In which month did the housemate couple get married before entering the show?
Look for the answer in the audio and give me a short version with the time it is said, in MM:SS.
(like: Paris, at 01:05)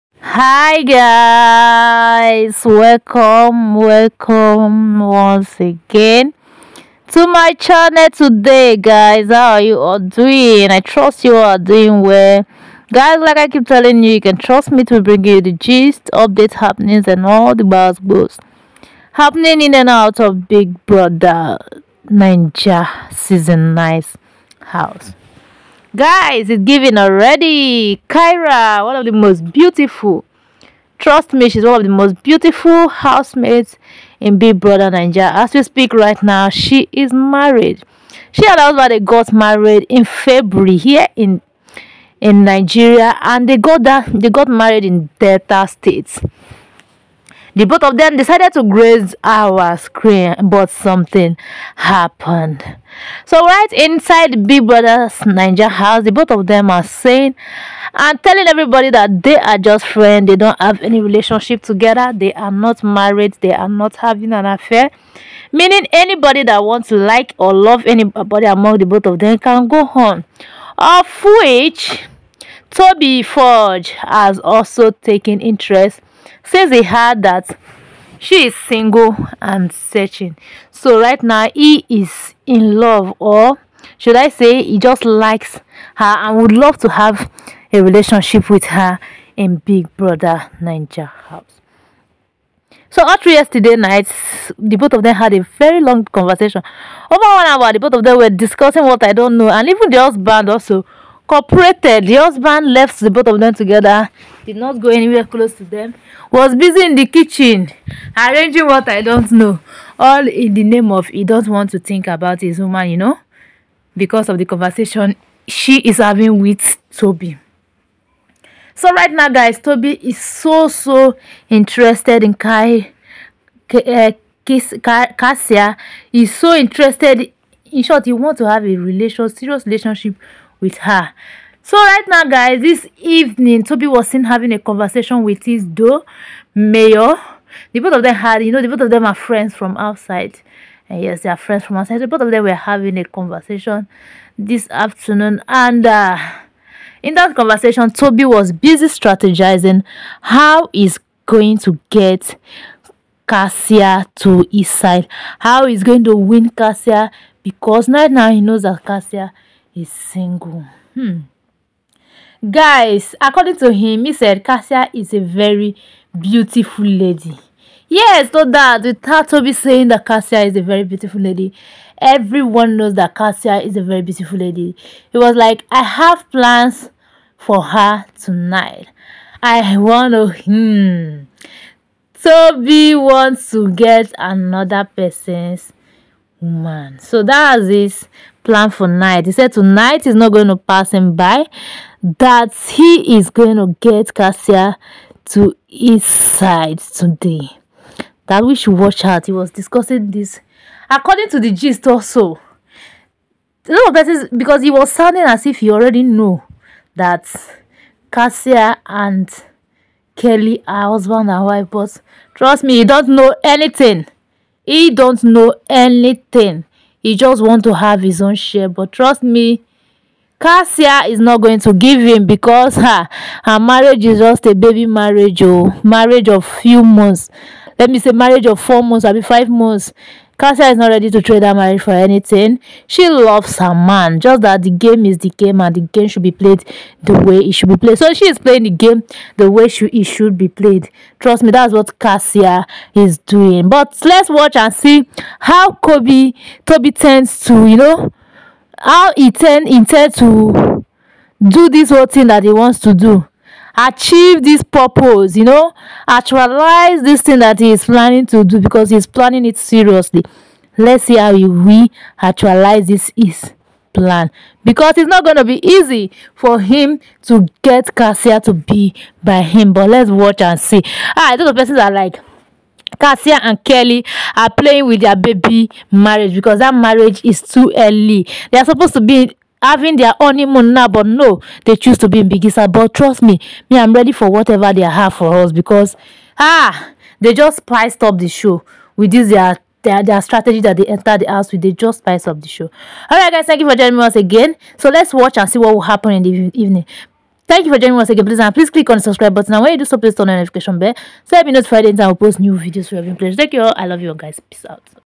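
February, at 00:40.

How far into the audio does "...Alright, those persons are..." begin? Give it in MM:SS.
04:31.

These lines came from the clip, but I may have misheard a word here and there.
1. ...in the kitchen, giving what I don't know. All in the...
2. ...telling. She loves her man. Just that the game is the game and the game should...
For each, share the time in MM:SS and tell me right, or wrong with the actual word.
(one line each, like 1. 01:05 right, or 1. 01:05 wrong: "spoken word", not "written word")
1. 01:46 wrong: "arranging", not "giving"
2. 03:51 wrong: "anything", not "telling".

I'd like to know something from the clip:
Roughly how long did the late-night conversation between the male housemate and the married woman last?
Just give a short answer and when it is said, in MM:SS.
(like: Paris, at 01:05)
Over one hour, at 01:37.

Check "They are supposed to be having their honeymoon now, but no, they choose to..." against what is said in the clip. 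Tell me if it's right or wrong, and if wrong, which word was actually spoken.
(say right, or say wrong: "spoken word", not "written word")
right.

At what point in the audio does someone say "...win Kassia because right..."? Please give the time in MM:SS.
02:36.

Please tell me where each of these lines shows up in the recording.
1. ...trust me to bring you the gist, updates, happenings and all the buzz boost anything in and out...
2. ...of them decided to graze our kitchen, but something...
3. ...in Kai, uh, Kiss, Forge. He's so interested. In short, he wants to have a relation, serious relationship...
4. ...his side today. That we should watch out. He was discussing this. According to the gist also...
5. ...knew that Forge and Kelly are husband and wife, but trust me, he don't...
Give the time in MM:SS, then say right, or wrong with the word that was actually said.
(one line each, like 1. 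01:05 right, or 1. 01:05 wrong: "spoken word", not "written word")
1. 00:14 wrong: "happening", not "anything"
2. 00:47 wrong: "screen", not "kitchen"
3. 02:02 wrong: "Kassia", not "Forge"
4. 03:15 right
5. 03:26 wrong: "Kassia", not "Forge".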